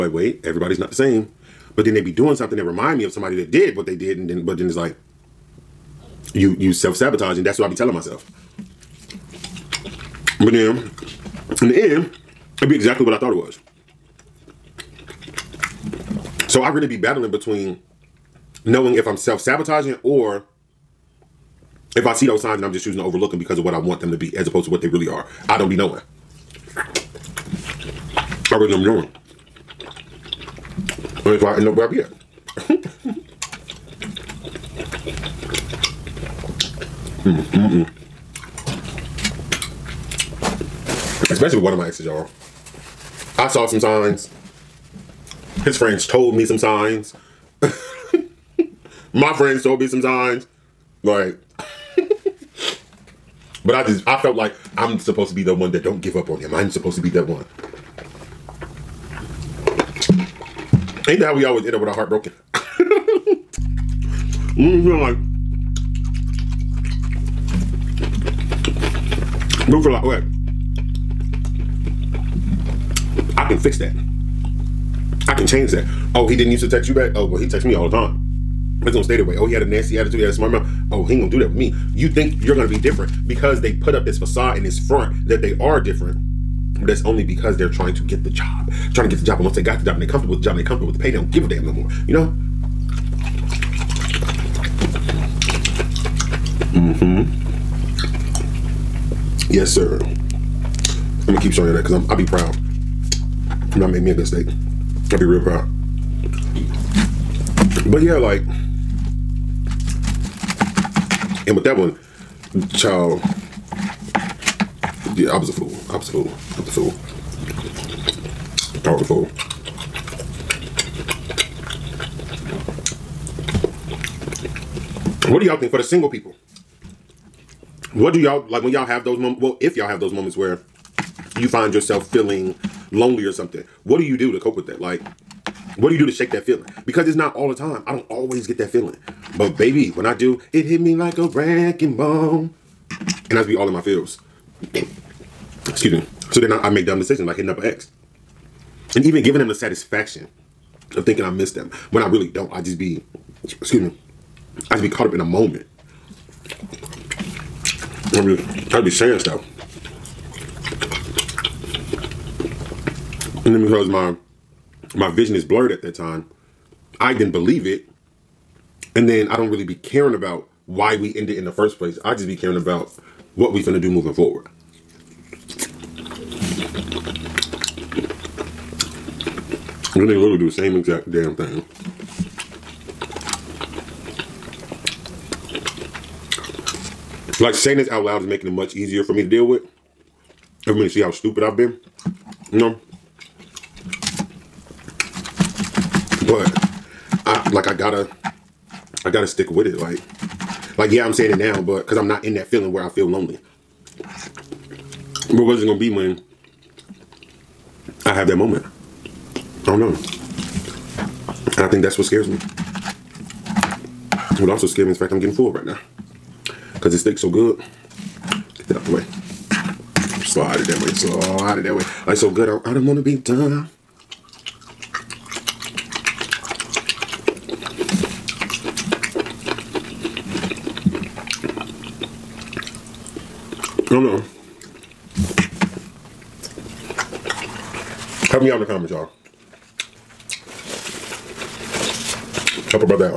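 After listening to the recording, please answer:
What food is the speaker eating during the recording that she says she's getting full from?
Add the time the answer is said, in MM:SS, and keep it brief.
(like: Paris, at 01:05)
steak, at 01:44.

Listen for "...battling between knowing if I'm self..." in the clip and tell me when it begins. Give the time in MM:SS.
00:16.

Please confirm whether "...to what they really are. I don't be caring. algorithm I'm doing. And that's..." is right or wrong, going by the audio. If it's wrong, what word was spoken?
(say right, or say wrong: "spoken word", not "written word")
wrong: "knowing", not "caring".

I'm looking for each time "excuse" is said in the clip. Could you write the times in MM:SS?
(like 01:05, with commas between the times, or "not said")
02:25, 02:33.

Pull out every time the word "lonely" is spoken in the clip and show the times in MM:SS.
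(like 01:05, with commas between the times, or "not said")
02:12, 03:23.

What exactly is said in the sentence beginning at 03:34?
What also scares me is the fact I'm getting full right now.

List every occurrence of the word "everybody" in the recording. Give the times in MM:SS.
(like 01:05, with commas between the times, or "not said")
00:00, 03:10.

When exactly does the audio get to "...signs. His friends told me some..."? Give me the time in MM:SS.
00:43.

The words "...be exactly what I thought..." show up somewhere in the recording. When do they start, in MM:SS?
00:12.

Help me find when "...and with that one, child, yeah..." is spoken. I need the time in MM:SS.
01:51.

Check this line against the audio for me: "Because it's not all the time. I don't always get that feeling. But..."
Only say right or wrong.
right.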